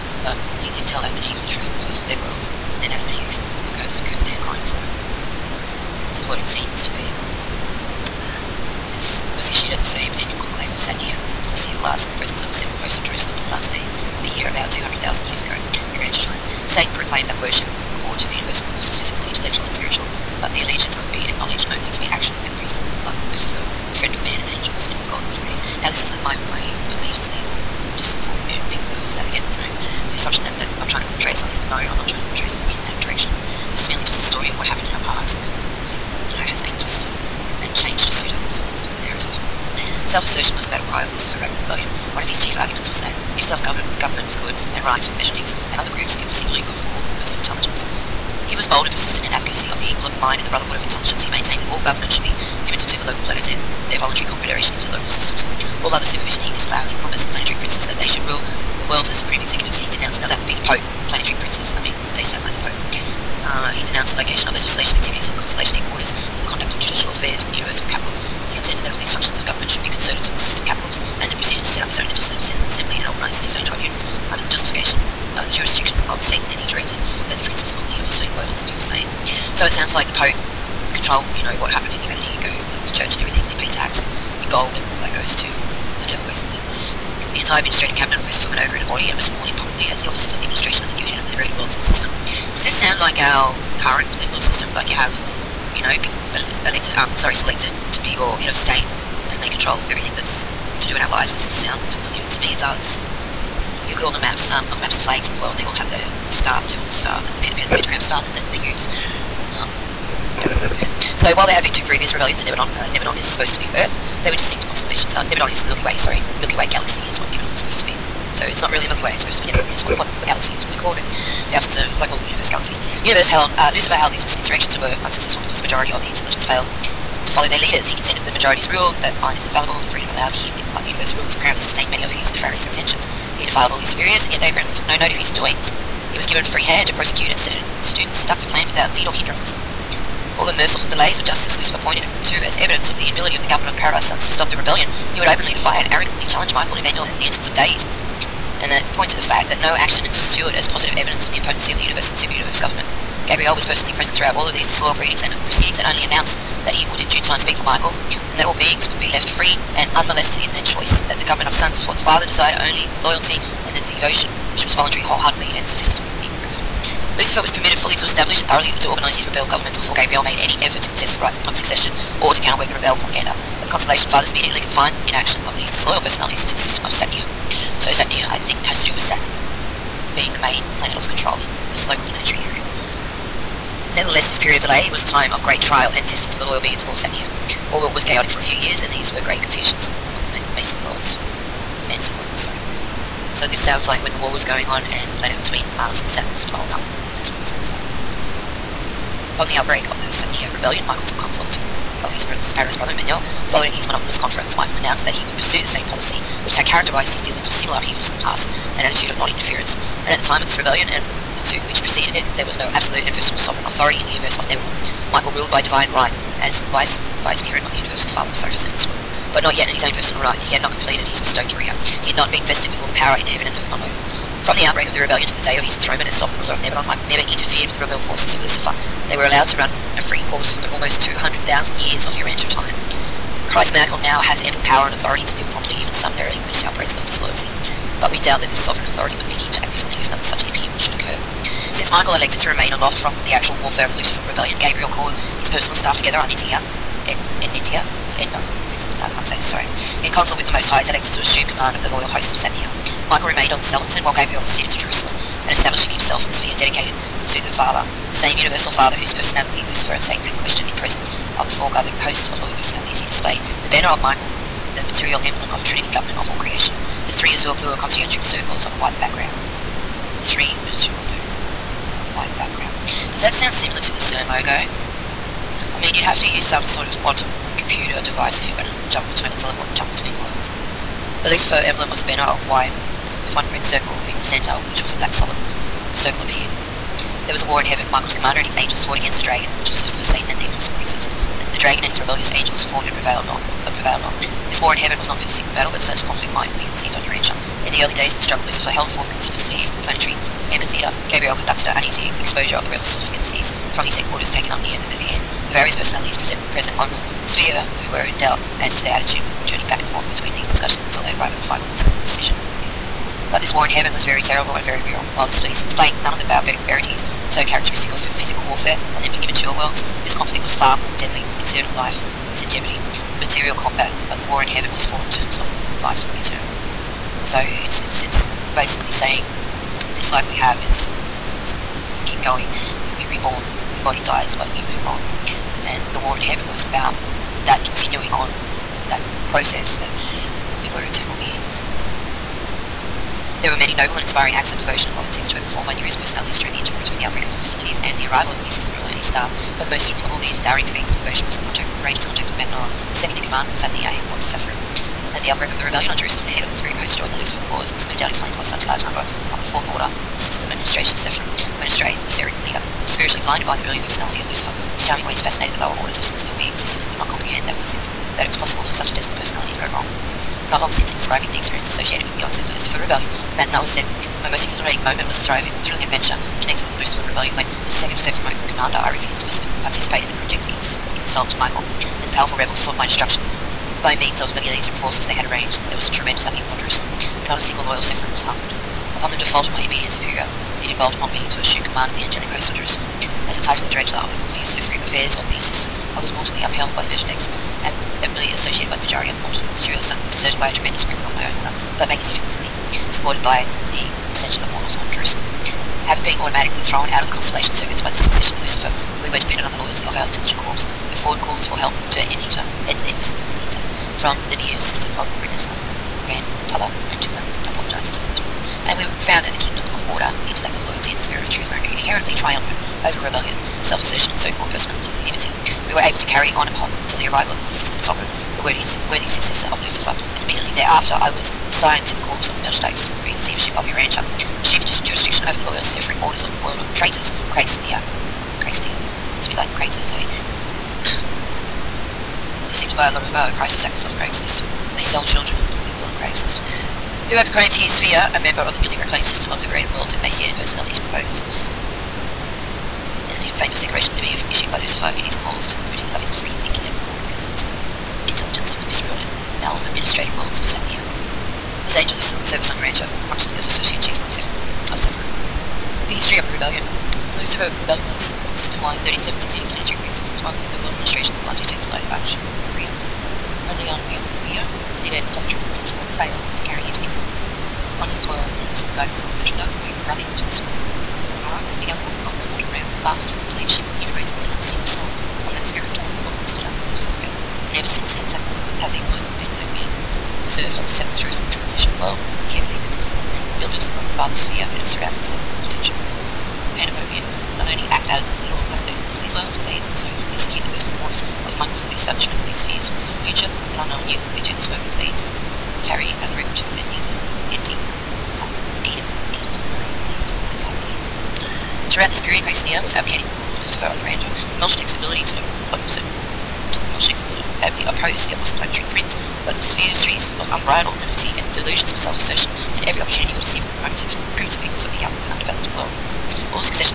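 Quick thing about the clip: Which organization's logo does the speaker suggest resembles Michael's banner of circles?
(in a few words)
CERN.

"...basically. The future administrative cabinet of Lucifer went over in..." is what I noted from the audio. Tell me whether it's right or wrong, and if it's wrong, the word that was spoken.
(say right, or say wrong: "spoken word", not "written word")
wrong: "entire", not "future".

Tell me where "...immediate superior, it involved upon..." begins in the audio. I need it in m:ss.
6:29.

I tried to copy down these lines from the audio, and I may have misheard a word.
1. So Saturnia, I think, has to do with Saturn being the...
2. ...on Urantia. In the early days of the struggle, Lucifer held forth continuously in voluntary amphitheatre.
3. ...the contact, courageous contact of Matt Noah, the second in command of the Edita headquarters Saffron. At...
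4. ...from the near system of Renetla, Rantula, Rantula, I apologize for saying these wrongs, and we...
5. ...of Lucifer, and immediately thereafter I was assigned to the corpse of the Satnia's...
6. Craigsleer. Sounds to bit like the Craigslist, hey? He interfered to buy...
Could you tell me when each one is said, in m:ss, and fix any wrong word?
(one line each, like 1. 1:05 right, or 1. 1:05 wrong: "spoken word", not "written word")
1. 2:57 right
2. 4:56 wrong: "planetary", not "voluntary"
3. 5:51 wrong: "Satniya", not "Edita"
4. 6:53 right
5. 7:09 wrong: "Melchizedek", not "Satnia"
6. 7:18 wrong: "seemed", not "interfered".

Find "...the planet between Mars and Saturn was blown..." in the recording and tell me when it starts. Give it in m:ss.
3:15.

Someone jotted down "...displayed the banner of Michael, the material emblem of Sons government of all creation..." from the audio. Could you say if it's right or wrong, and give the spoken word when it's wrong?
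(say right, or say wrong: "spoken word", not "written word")
wrong: "Trinity", not "Sons".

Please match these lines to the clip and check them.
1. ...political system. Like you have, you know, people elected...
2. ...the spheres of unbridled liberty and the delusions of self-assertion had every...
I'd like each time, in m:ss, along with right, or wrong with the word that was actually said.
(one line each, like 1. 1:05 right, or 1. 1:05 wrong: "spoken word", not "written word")
1. 1:34 right
2. 8:39 right.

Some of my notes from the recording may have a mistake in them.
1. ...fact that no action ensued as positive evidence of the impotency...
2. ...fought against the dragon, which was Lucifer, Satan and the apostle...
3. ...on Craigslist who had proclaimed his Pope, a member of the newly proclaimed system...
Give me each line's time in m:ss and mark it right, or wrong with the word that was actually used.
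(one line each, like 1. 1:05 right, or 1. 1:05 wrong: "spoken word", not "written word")
1. 2:29 right
2. 4:48 right
3. 7:25 wrong: "Sphere", not "Pope".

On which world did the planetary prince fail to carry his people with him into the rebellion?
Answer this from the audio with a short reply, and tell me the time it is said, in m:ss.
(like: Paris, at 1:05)
Panthropia, at 7:53.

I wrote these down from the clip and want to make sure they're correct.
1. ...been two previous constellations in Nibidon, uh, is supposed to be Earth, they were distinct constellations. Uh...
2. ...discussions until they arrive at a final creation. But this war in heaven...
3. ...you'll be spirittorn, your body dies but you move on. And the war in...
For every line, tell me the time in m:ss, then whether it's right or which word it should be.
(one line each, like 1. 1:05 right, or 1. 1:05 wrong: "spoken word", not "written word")
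1. 1:51 wrong: "rebellions", not "constellations"
2. 5:10 wrong: "decision", not "creation"
3. 5:32 wrong: "reborn", not "spirittorn".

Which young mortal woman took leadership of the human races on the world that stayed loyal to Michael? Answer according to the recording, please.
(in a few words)
Eleanora.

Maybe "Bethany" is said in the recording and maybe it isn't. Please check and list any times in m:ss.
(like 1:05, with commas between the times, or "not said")
not said.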